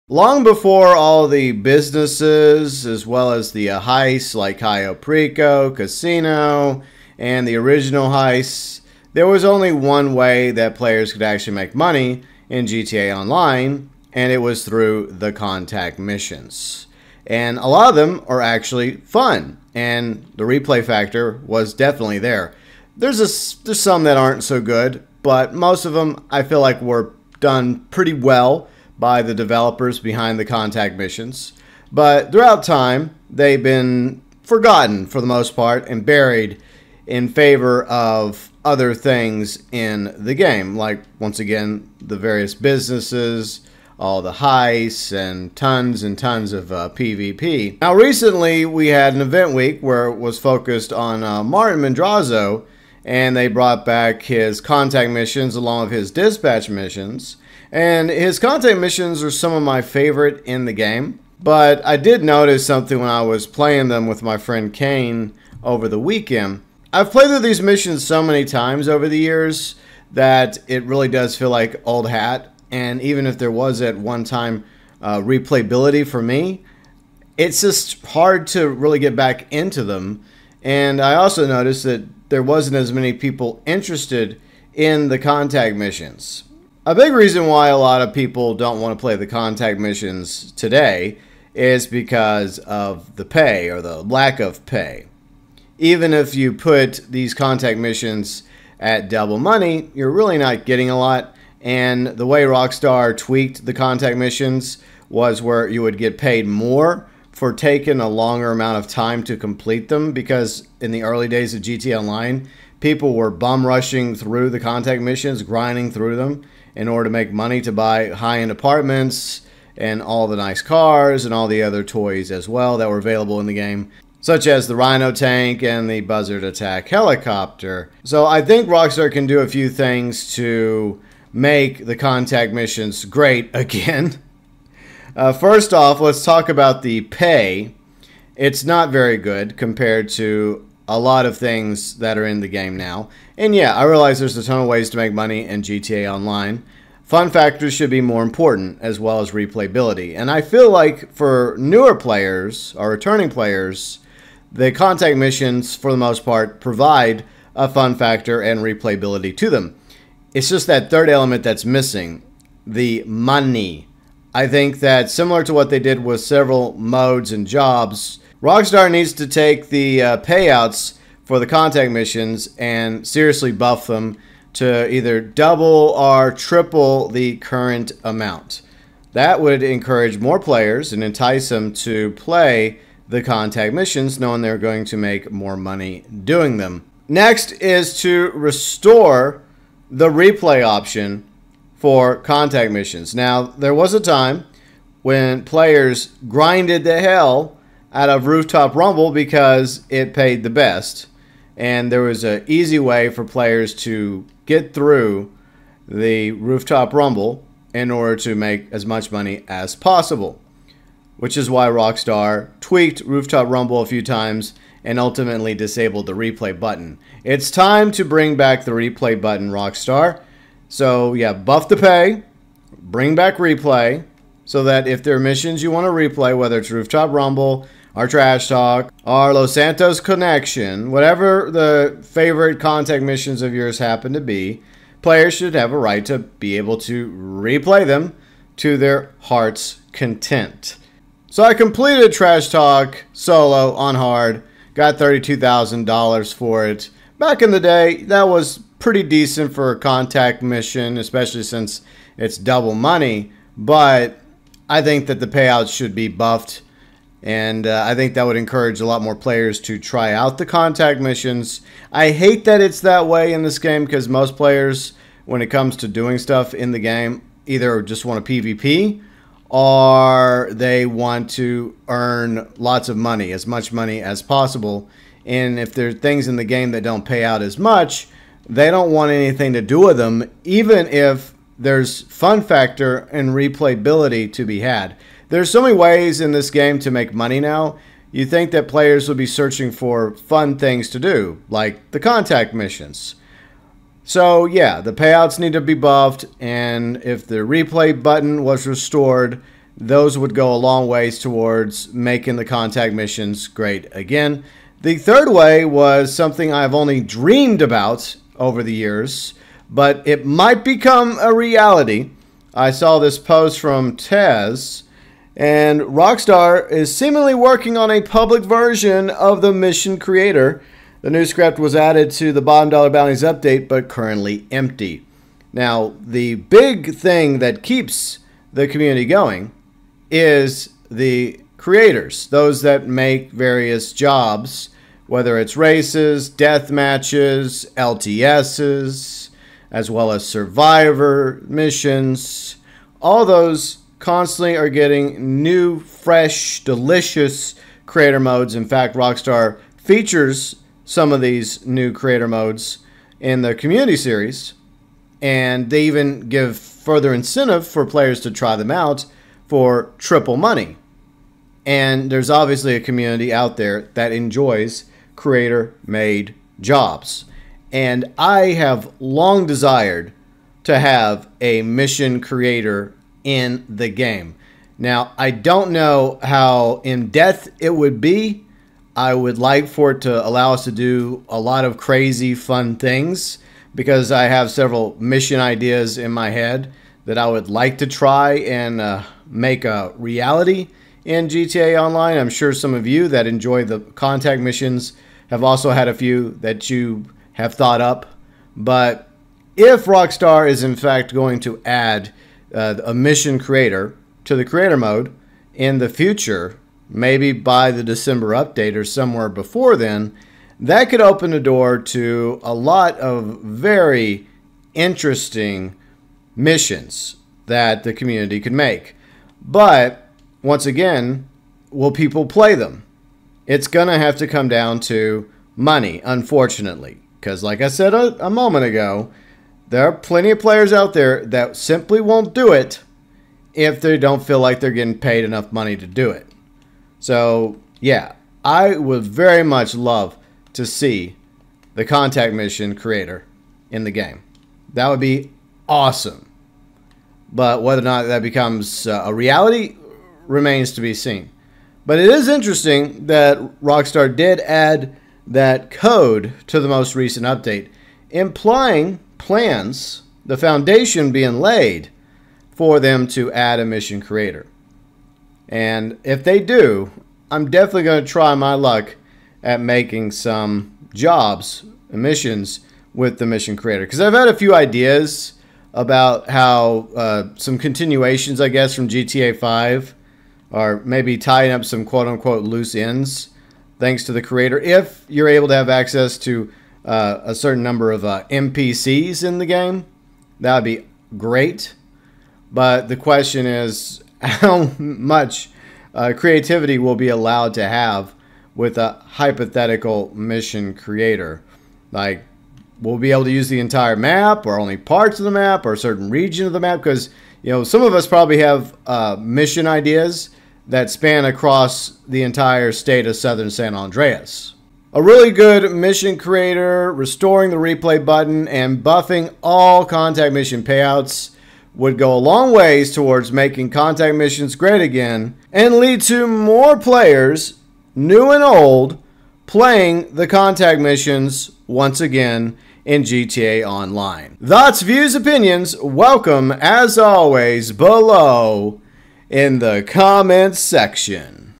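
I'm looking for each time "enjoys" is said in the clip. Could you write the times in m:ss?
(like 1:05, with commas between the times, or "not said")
6:04, 6:33.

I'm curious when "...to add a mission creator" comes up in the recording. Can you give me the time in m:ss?
7:43.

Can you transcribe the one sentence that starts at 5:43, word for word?
All those constantly are getting new, fresh, delicious creator modes.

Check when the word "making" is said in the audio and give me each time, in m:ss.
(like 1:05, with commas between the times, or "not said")
5:01, 7:49, 8:43.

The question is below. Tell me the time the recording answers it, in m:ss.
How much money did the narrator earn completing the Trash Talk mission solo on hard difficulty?
4:04.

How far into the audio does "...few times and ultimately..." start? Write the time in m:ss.
3:33.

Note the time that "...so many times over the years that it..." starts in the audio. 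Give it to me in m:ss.
1:08.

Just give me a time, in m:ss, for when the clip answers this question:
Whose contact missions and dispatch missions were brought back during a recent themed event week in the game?
0:51.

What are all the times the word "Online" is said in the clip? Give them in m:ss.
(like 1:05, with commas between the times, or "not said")
0:13, 1:51, 2:26, 6:31, 8:53.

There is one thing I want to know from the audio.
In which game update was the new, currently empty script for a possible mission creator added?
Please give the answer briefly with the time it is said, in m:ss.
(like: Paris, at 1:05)
Bottom Dollar Bounties, at 5:22.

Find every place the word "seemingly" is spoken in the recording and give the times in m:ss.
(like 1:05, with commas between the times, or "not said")
5:16.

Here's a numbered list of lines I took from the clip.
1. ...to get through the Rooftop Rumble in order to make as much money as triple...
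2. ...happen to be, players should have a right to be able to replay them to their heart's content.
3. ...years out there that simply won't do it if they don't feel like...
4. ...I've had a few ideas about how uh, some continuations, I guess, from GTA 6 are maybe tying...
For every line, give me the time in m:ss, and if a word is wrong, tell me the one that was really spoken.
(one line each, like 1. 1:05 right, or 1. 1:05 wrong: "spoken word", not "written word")
1. 3:23 wrong: "possible", not "triple"
2. 3:53 right
3. 7:10 wrong: "players", not "years"
4. 7:54 wrong: "5", not "6".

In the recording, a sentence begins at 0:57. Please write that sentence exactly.
And his contact missions are some of my favorite in the game.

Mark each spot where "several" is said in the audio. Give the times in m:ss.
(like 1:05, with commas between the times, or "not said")
2:46, 6:24.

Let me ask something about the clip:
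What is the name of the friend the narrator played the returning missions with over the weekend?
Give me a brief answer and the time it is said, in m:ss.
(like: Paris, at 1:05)
Kane, at 1:04.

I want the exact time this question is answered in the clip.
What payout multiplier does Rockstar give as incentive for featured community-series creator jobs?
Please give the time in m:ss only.
5:59.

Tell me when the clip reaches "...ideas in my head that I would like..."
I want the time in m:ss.
6:25.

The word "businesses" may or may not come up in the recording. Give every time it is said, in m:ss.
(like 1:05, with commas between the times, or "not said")
0:01, 0:42.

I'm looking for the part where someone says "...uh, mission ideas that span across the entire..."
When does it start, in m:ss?
8:28.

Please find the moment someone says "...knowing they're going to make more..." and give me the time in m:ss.
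3:04.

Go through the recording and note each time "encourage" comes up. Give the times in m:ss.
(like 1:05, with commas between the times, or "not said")
2:59, 4:18.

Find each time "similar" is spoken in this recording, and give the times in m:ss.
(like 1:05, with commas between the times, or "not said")
2:45.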